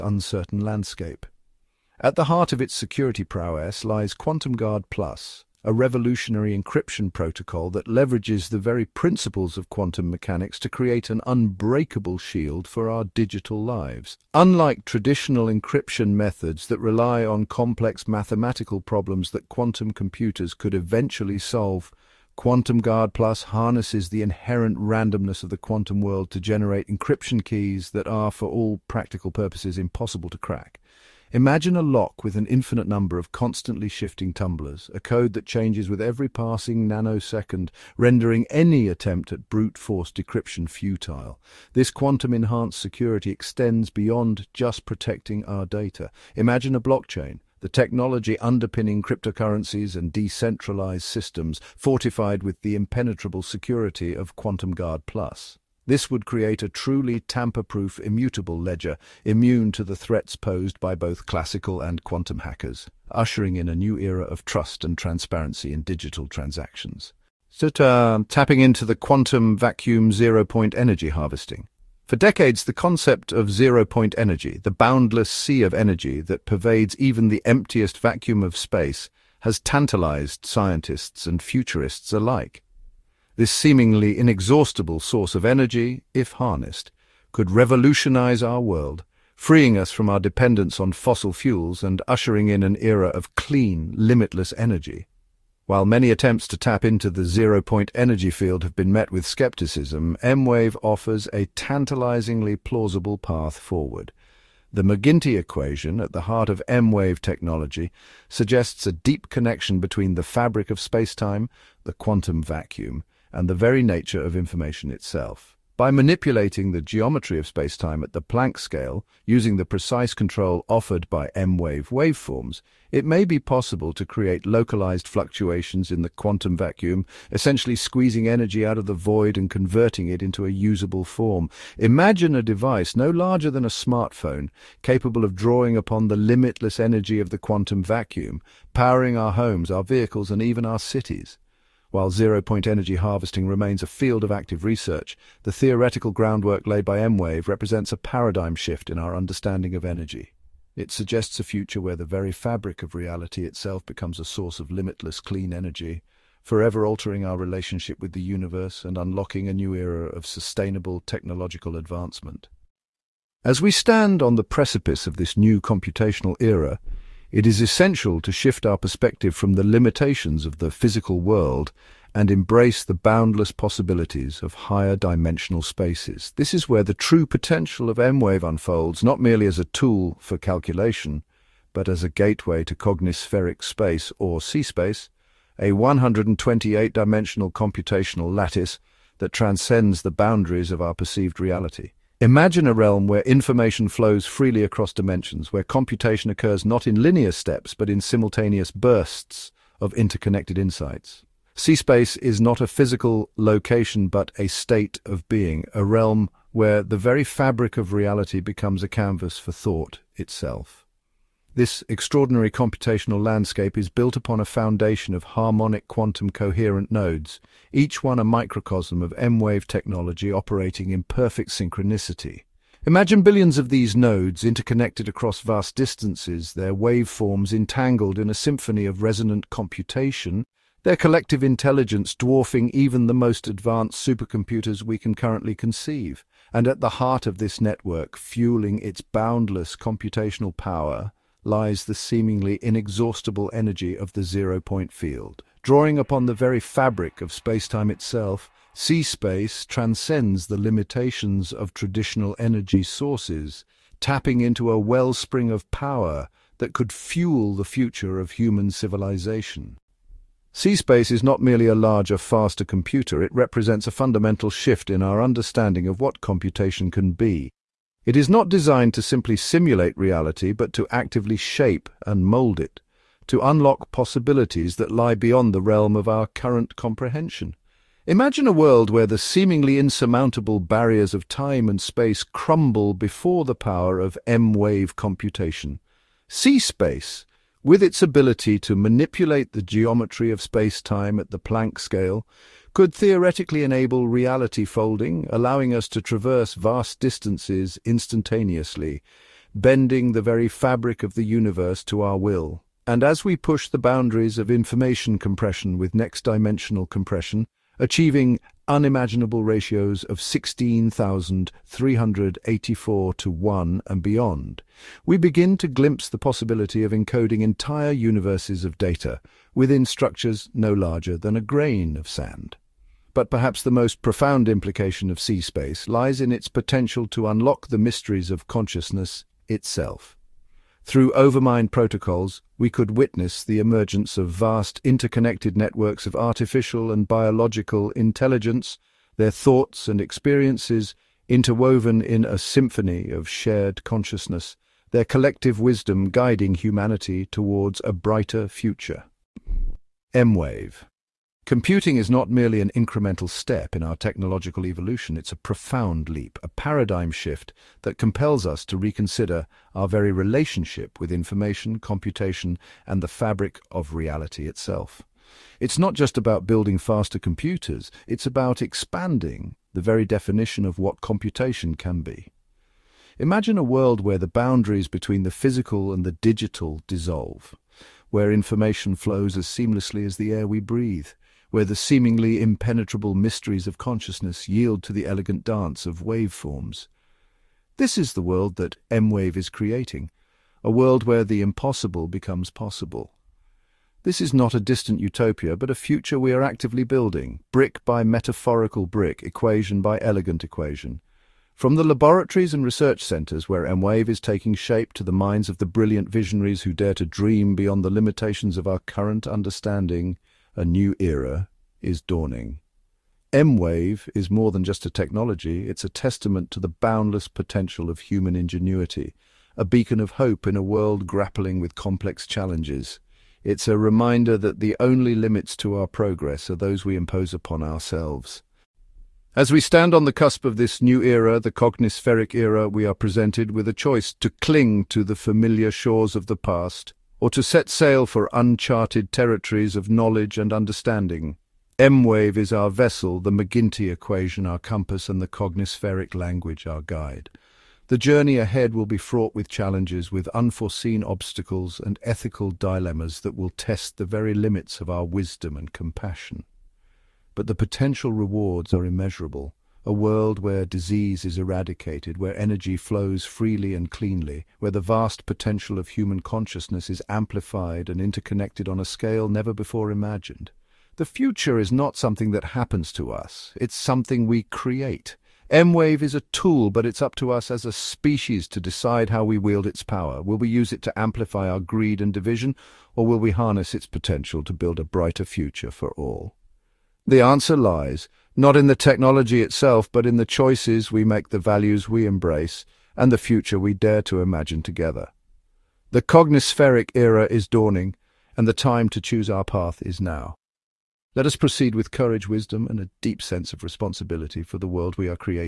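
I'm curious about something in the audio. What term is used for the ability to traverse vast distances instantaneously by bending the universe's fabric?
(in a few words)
Reality folding.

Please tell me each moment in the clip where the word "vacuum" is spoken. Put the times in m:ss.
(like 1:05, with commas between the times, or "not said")
1:09, 1:17, 1:52, 2:06, 2:17.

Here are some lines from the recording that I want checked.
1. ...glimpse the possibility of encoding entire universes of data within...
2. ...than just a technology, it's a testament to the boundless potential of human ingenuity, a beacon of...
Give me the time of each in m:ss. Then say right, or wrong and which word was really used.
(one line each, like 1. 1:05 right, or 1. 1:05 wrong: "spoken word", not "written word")
1. 5:15 right
2. 6:54 right.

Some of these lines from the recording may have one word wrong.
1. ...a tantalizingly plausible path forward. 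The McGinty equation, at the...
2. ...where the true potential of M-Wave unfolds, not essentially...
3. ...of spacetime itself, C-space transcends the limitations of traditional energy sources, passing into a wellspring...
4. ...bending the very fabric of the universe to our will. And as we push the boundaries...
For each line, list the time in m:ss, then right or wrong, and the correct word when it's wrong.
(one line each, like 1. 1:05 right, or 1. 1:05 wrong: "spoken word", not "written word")
1. 1:41 right
2. 2:56 wrong: "merely", not "essentially"
3. 4:07 wrong: "tapping", not "passing"
4. 4:59 right.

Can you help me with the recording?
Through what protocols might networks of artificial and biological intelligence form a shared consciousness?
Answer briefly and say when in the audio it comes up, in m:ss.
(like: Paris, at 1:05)
Overmind protocols, at 5:31.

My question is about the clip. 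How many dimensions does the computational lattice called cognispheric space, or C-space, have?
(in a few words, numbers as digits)
128.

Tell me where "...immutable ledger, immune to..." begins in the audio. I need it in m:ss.
0:57.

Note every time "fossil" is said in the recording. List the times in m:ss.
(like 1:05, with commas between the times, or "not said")
1:30.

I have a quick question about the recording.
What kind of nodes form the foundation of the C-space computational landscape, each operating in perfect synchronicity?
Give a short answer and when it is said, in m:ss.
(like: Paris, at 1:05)
Harmonic quantum coherent nodes, at 3:35.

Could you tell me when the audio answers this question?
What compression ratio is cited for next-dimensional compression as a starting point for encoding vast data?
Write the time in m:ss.
5:10.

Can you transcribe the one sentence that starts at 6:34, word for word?
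This is not a distant utopia, but a future we are actively building, brick by metaphorical brick, equation by elegant equation.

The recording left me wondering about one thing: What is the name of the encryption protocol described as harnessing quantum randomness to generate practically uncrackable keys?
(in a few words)
QuantumGuard Plus.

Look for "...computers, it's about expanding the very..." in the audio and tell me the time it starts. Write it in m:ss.
6:07.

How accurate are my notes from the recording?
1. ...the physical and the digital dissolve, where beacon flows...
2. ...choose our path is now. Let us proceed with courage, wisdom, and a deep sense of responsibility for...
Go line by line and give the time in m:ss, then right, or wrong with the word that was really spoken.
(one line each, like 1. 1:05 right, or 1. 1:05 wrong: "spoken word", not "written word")
1. 6:15 wrong: "information", not "beacon"
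2. 8:19 right.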